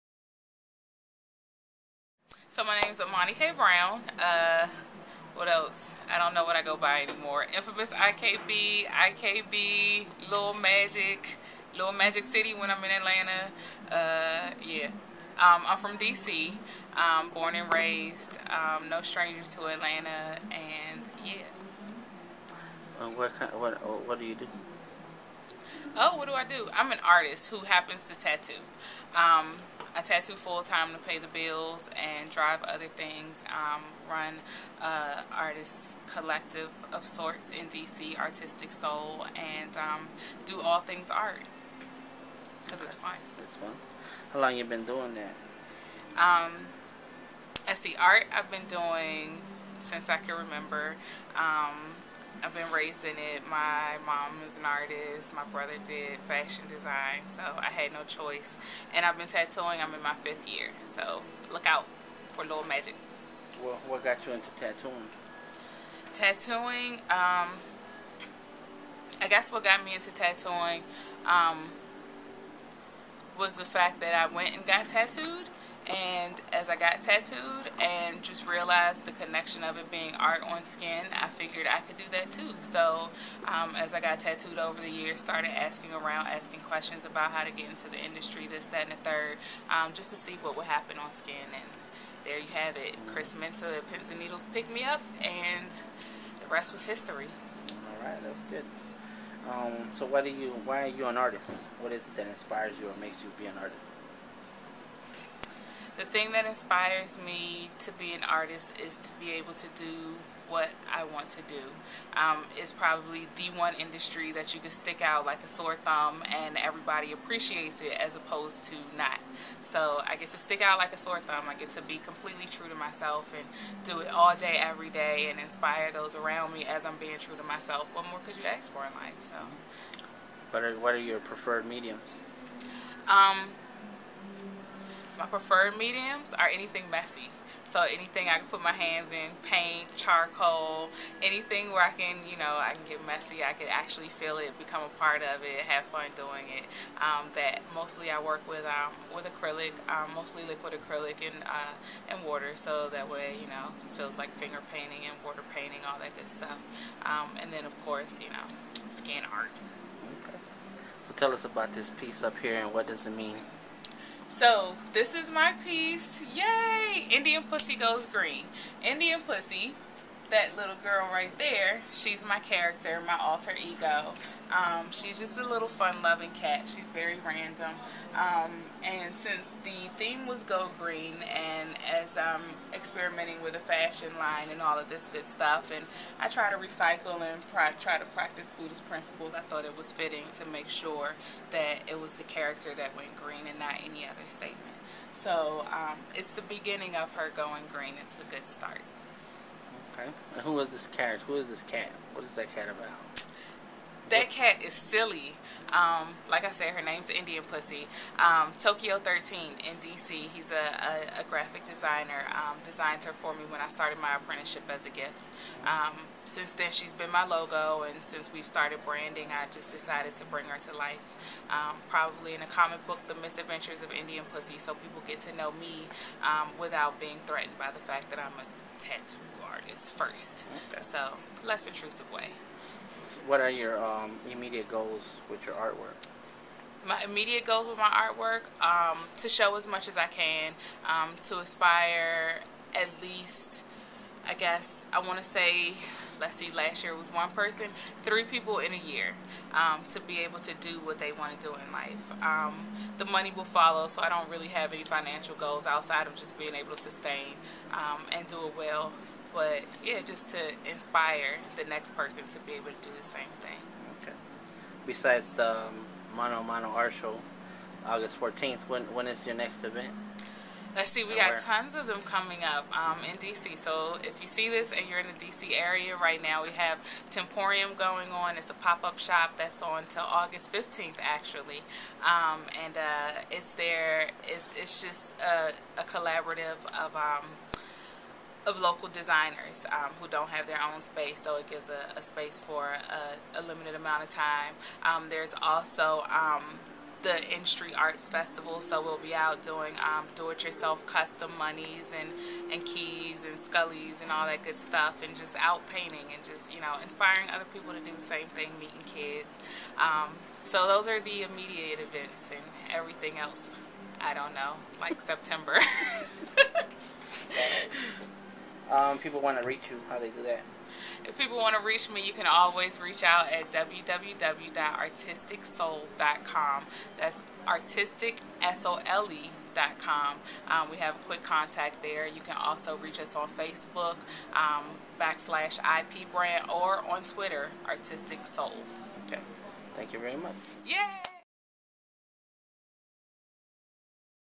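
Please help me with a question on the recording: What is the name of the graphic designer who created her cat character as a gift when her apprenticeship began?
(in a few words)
Tokyo 13.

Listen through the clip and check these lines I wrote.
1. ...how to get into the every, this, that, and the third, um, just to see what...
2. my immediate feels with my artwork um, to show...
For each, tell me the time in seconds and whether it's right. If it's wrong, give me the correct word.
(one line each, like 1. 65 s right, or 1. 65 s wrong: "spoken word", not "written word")
1. 87 s wrong: "industry", not "every"
2. 236 s wrong: "goals", not "feels".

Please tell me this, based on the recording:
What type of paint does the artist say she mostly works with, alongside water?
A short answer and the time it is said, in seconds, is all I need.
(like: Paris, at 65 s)
Liquid acrylic, at 150 s.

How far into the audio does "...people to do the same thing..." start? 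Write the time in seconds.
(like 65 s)
307 s.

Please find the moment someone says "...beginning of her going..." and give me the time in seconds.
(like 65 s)
196 s.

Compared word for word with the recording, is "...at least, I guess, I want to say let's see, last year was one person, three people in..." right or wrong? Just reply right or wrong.
right.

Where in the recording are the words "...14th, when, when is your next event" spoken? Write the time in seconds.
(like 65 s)
268 s.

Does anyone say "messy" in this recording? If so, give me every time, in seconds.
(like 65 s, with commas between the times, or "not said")
136 s, 143 s.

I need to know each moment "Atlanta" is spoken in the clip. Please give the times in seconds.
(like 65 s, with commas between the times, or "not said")
12 s, 19 s.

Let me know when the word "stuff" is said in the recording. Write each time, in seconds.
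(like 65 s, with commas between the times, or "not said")
156 s, 185 s, 304 s.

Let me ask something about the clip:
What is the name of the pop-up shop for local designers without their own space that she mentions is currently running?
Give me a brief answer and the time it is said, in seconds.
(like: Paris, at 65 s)
Temporium, at 277 s.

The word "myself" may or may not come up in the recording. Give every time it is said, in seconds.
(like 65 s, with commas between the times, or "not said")
122 s, 127 s.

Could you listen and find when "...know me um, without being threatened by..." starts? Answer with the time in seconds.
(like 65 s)
225 s.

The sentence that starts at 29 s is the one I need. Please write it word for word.
Um, I tattoo full time to pay the bills and drive other things.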